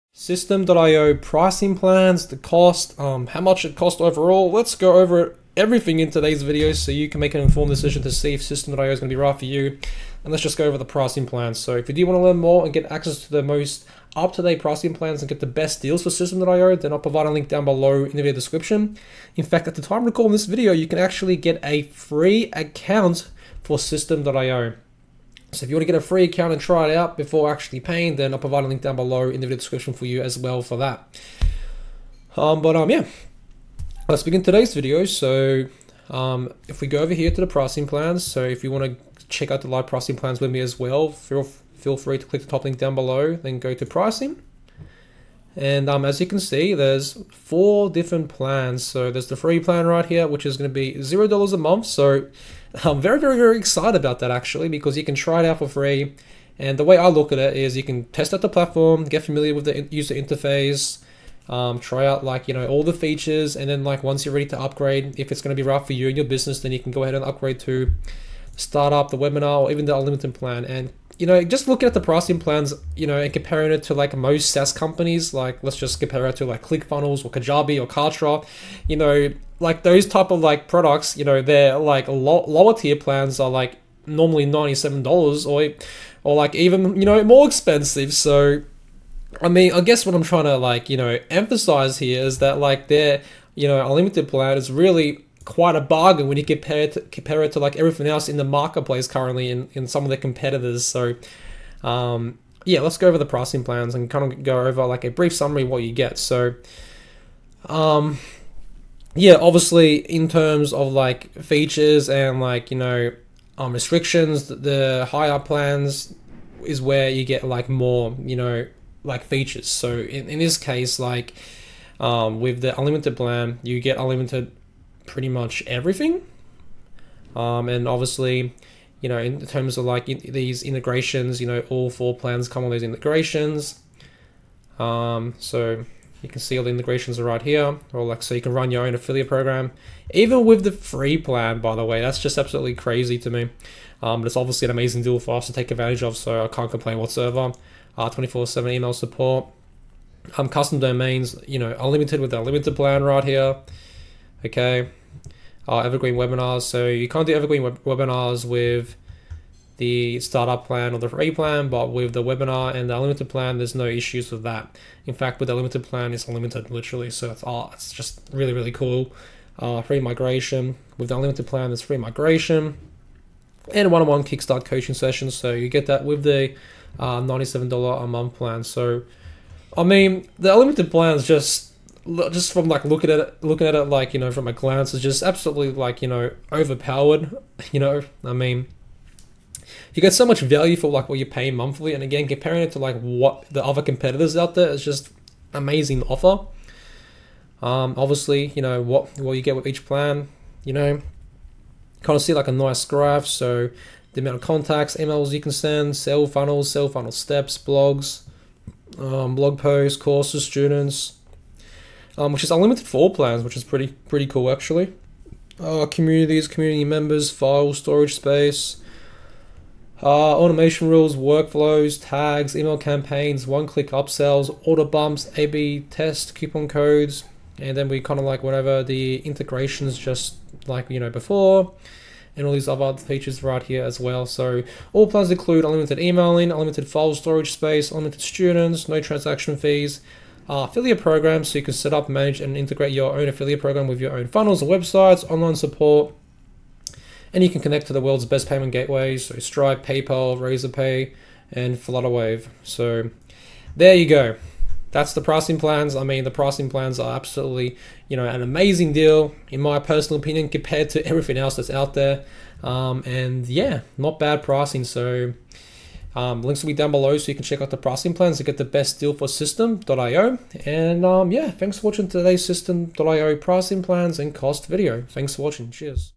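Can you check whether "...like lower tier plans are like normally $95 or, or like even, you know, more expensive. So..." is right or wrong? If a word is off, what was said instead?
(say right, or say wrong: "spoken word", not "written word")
wrong: "97", not "95".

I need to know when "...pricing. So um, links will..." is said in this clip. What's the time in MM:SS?
04:24.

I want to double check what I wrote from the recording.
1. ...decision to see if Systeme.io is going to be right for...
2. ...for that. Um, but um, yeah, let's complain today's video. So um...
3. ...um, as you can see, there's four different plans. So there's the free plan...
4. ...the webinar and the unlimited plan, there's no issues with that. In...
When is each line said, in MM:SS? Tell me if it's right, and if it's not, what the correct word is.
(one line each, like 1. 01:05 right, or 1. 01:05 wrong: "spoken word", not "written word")
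1. 00:07 right
2. 00:30 wrong: "begin", not "complain"
3. 00:45 right
4. 02:42 right.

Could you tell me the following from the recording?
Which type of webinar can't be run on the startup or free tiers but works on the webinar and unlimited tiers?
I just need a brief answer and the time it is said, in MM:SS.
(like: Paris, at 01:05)
Evergreen webinars, at 02:35.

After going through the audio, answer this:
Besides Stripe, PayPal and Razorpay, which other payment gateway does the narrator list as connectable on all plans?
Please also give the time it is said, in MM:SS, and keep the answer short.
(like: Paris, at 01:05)
Flutterwave, at 04:11.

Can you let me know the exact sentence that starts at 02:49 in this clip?
Uh, free migration with the unlimited plan, there's free migration and one-on-one -on -one kickstart coaching sessions.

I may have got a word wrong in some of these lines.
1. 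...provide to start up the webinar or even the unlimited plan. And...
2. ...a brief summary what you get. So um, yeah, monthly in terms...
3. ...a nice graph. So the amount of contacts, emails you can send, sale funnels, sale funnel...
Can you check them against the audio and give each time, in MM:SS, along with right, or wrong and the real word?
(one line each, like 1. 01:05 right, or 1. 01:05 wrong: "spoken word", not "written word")
1. 01:07 wrong: "upgrade", not "provide"
2. 01:45 wrong: "obviously", not "monthly"
3. 03:22 right.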